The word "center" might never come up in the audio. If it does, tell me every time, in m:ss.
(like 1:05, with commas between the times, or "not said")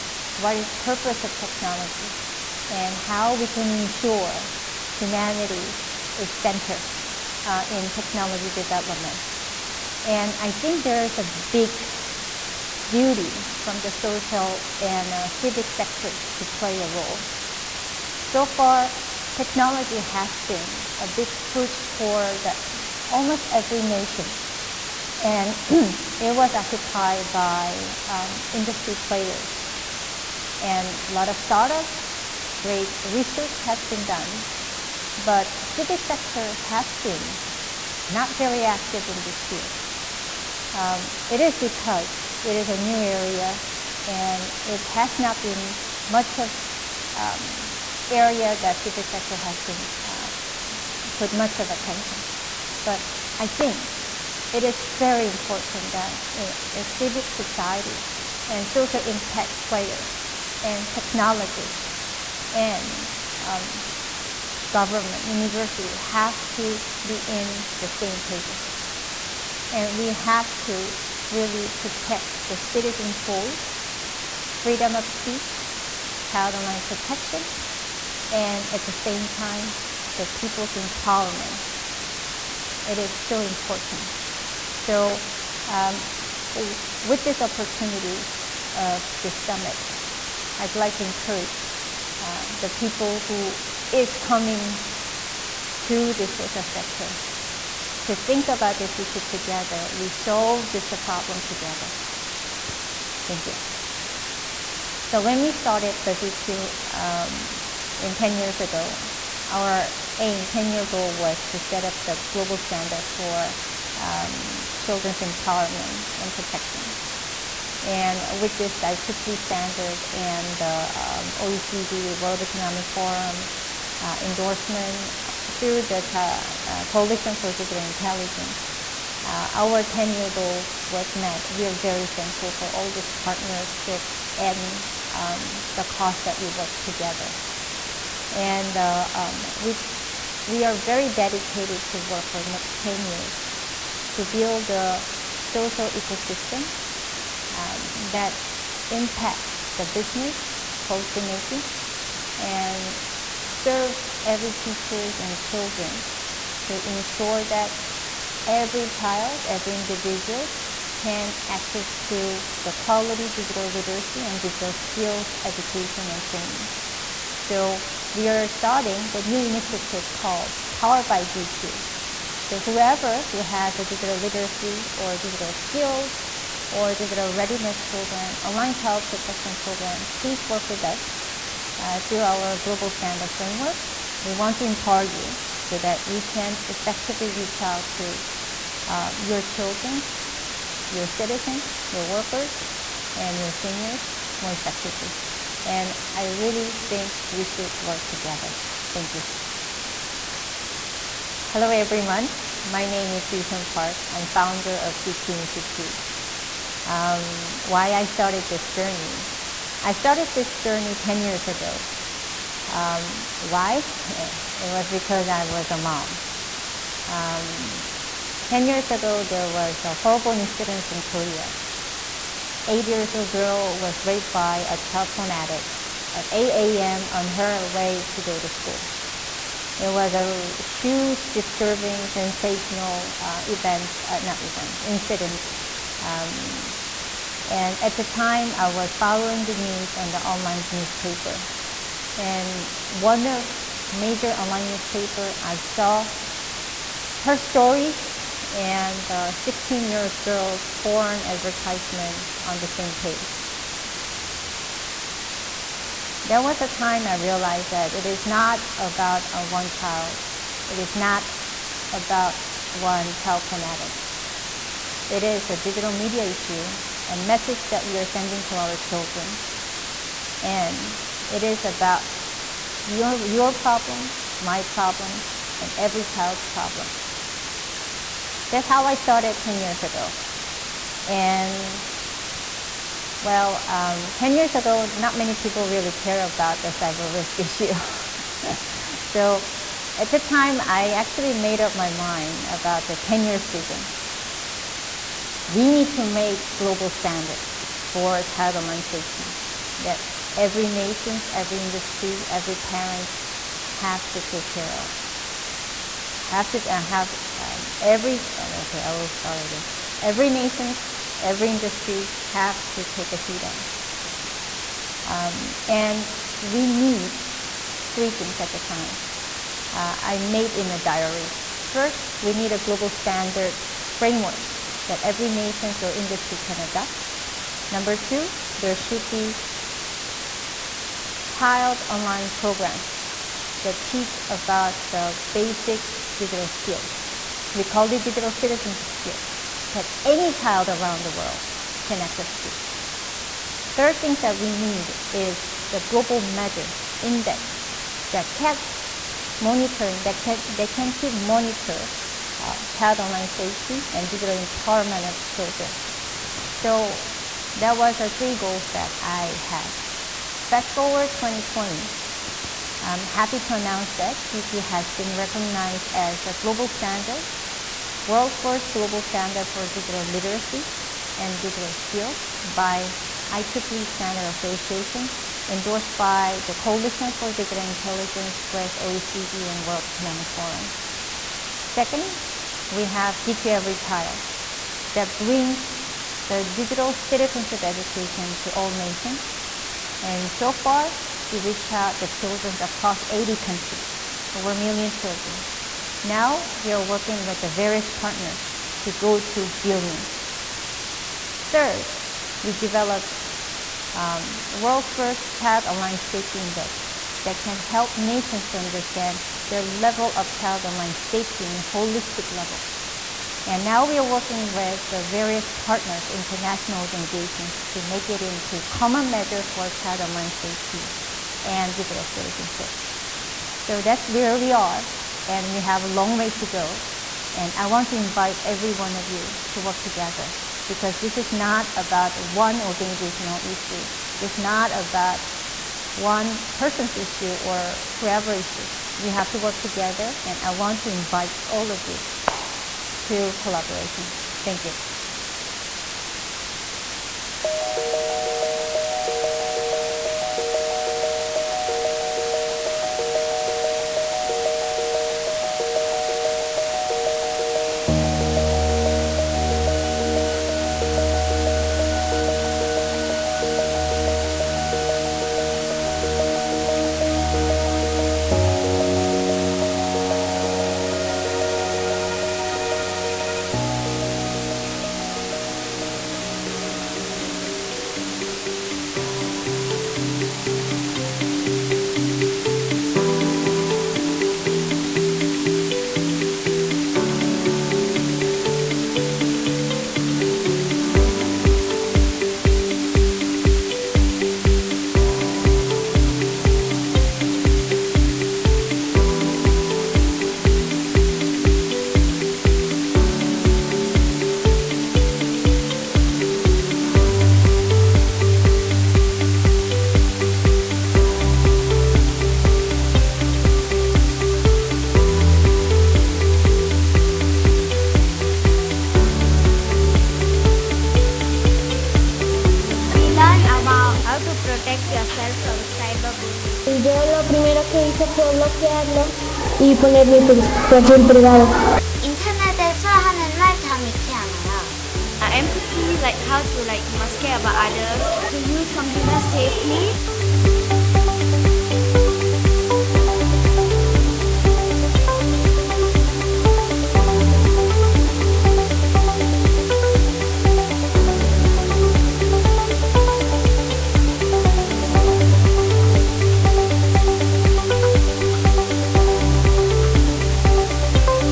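0:06.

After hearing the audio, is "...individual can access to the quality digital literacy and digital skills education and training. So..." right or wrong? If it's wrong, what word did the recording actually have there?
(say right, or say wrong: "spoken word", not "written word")
right.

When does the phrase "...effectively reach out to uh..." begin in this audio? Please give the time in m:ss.
3:06.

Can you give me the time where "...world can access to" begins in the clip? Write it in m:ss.
5:41.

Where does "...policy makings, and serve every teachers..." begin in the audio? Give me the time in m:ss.
2:30.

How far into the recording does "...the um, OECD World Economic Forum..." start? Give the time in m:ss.
2:00.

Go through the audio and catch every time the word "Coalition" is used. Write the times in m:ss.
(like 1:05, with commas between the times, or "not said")
2:06, 6:16.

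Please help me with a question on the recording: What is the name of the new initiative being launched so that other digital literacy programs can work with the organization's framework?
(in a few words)
Powered by DQ.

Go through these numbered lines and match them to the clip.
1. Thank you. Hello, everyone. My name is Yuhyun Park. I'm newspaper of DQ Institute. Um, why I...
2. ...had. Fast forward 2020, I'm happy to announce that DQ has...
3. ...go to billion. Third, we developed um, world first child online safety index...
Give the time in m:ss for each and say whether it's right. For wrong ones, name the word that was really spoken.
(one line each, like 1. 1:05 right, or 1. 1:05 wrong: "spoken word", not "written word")
1. 3:18 wrong: "founder", not "newspaper"
2. 5:59 right
3. 6:38 right.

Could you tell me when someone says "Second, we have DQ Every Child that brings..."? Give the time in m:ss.
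6:21.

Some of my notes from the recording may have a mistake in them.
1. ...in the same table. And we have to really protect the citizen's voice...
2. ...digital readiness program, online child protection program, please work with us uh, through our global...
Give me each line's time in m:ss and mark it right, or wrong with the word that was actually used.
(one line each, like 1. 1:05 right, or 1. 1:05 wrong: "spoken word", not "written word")
1. 1:07 right
2. 2:56 right.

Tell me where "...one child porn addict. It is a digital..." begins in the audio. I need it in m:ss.
4:22.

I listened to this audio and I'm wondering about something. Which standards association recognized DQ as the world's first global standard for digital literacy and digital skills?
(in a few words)
IEEE Standard Association.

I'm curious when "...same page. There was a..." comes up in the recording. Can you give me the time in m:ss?
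4:12.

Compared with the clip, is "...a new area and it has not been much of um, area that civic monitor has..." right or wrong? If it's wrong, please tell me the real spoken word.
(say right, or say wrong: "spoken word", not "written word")
wrong: "sector", not "monitor".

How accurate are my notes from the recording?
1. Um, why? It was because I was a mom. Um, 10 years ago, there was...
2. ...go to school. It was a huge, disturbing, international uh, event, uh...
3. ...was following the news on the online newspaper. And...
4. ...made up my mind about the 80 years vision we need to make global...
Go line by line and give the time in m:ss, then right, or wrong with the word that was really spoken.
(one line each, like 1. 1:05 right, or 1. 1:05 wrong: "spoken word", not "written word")
1. 3:32 right
2. 3:48 wrong: "sensational", not "international"
3. 3:58 right
4. 4:51 wrong: "10", not "80".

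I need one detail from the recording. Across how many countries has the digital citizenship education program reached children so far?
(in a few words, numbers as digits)
80.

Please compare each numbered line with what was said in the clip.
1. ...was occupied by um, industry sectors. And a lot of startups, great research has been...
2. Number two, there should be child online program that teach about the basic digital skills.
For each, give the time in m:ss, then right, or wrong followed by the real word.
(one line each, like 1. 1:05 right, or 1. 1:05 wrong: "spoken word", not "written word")
1. 0:26 wrong: "players", not "sectors"
2. 5:27 right.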